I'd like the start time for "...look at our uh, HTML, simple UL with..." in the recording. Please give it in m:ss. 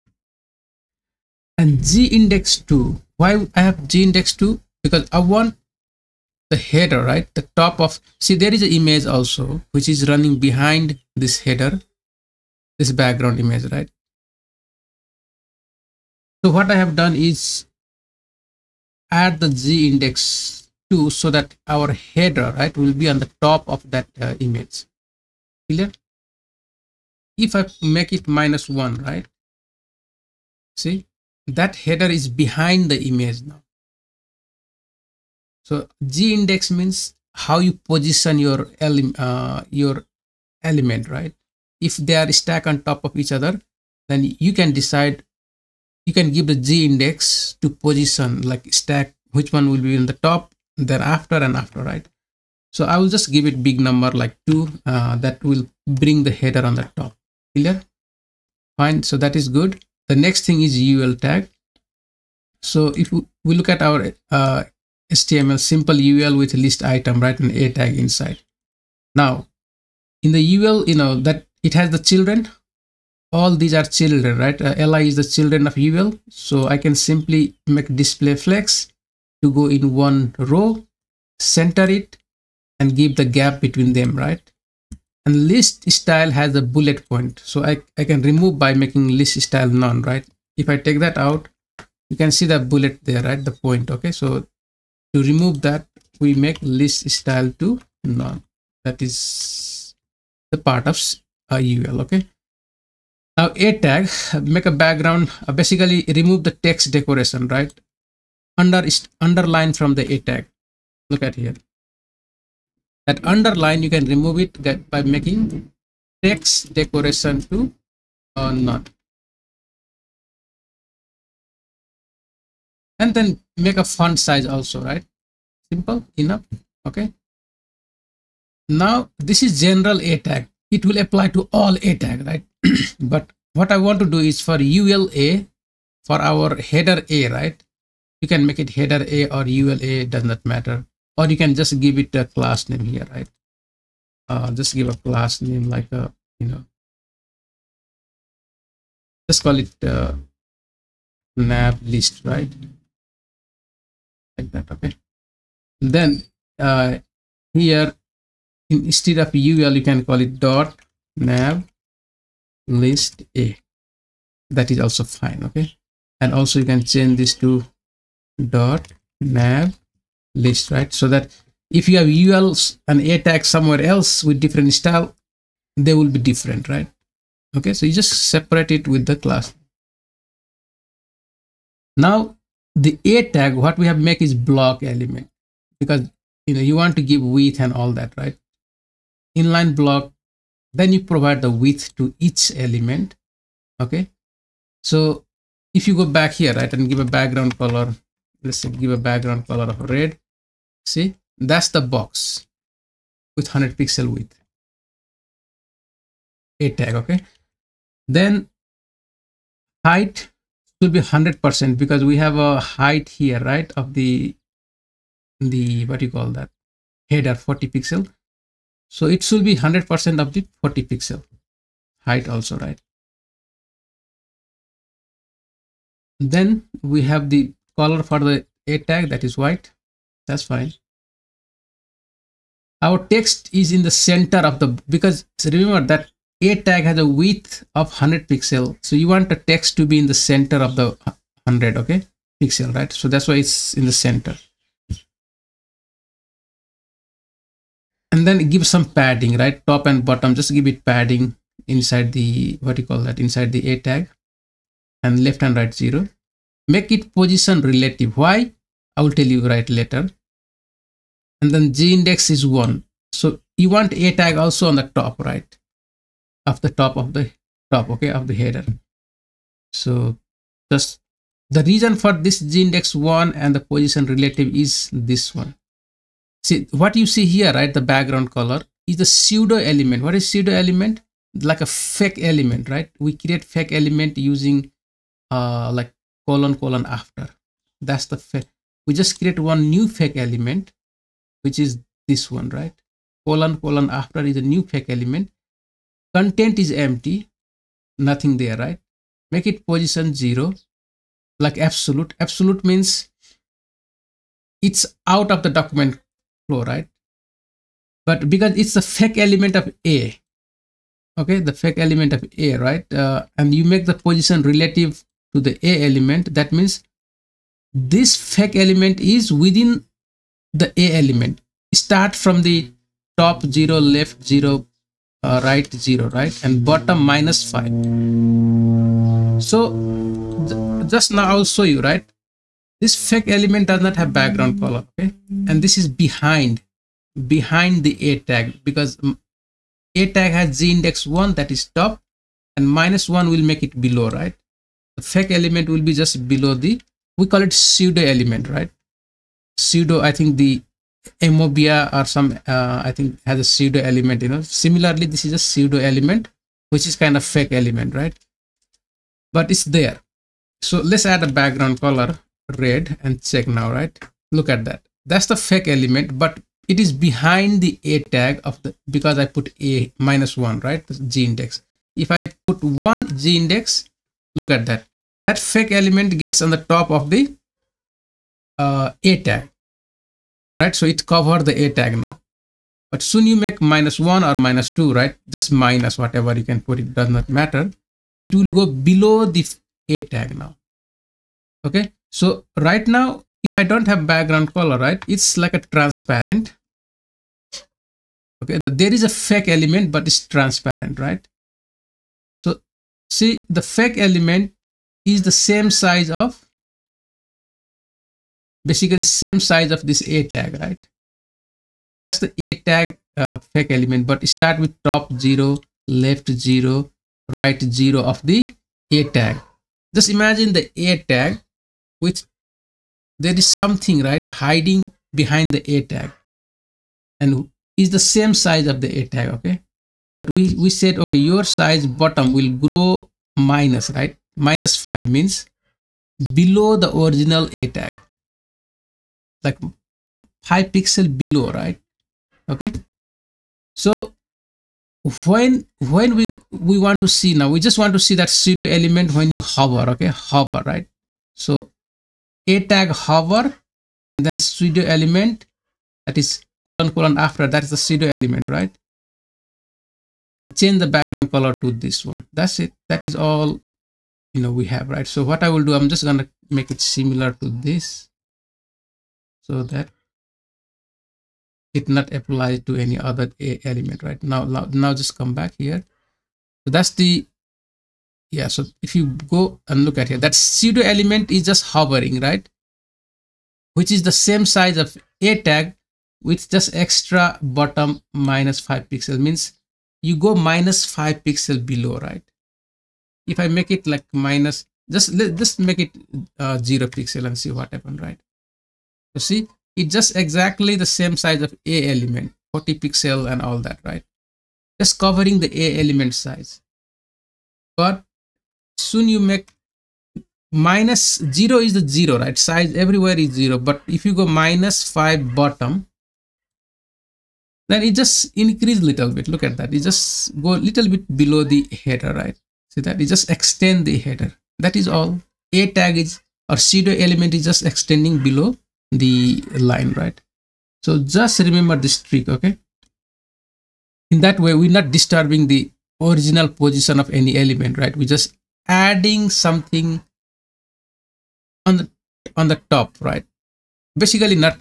1:03.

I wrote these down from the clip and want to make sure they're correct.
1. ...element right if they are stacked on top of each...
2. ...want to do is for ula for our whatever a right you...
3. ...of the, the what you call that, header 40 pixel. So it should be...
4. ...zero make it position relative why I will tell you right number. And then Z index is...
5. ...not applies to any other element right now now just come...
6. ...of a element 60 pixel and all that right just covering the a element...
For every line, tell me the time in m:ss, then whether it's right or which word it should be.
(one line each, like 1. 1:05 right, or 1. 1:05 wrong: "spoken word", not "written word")
1. 0:40 right
2. 2:13 wrong: "header", not "whatever"
3. 3:33 right
4. 4:15 wrong: "later", not "number"
5. 7:51 right
6. 8:21 wrong: "40", not "60".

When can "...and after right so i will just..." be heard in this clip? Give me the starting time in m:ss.
0:51.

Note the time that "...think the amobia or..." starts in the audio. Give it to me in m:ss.
5:50.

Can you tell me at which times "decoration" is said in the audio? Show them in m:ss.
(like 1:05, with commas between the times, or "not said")
1:46, 1:56.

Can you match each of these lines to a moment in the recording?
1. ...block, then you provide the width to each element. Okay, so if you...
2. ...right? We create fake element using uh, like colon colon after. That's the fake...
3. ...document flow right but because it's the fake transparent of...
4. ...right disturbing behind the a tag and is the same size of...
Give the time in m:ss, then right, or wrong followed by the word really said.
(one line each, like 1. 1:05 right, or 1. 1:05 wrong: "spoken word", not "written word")
1. 3:09 right
2. 4:42 right
3. 5:05 wrong: "element", not "transparent"
4. 7:04 wrong: "hiding", not "disturbing".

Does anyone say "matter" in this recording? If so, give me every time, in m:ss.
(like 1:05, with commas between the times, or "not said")
2:20, 6:27.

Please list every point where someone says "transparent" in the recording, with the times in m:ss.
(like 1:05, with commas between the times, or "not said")
6:35, 6:40.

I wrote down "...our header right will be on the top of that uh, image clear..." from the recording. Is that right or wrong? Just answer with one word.
right.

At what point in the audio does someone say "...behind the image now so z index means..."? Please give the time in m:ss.
0:32.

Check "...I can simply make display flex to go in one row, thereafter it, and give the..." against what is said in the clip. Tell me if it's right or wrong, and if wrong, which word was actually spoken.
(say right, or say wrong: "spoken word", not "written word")
wrong: "center", not "thereafter".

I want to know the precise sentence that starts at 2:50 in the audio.
So that if you have ULs and A tags somewhere else with different style, they will be different, right?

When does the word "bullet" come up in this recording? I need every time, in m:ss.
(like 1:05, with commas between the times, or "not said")
1:26, 1:32.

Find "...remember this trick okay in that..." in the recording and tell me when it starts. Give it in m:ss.
8:51.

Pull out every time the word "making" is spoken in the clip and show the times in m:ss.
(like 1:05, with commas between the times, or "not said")
1:28, 1:55.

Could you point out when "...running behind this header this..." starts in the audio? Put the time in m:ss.
0:10.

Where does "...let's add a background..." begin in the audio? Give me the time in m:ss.
6:00.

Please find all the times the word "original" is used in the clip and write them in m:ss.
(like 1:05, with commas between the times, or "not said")
7:16, 8:56.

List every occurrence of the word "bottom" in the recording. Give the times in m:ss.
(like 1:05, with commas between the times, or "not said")
4:10, 5:26, 7:12, 8:07, 8:35.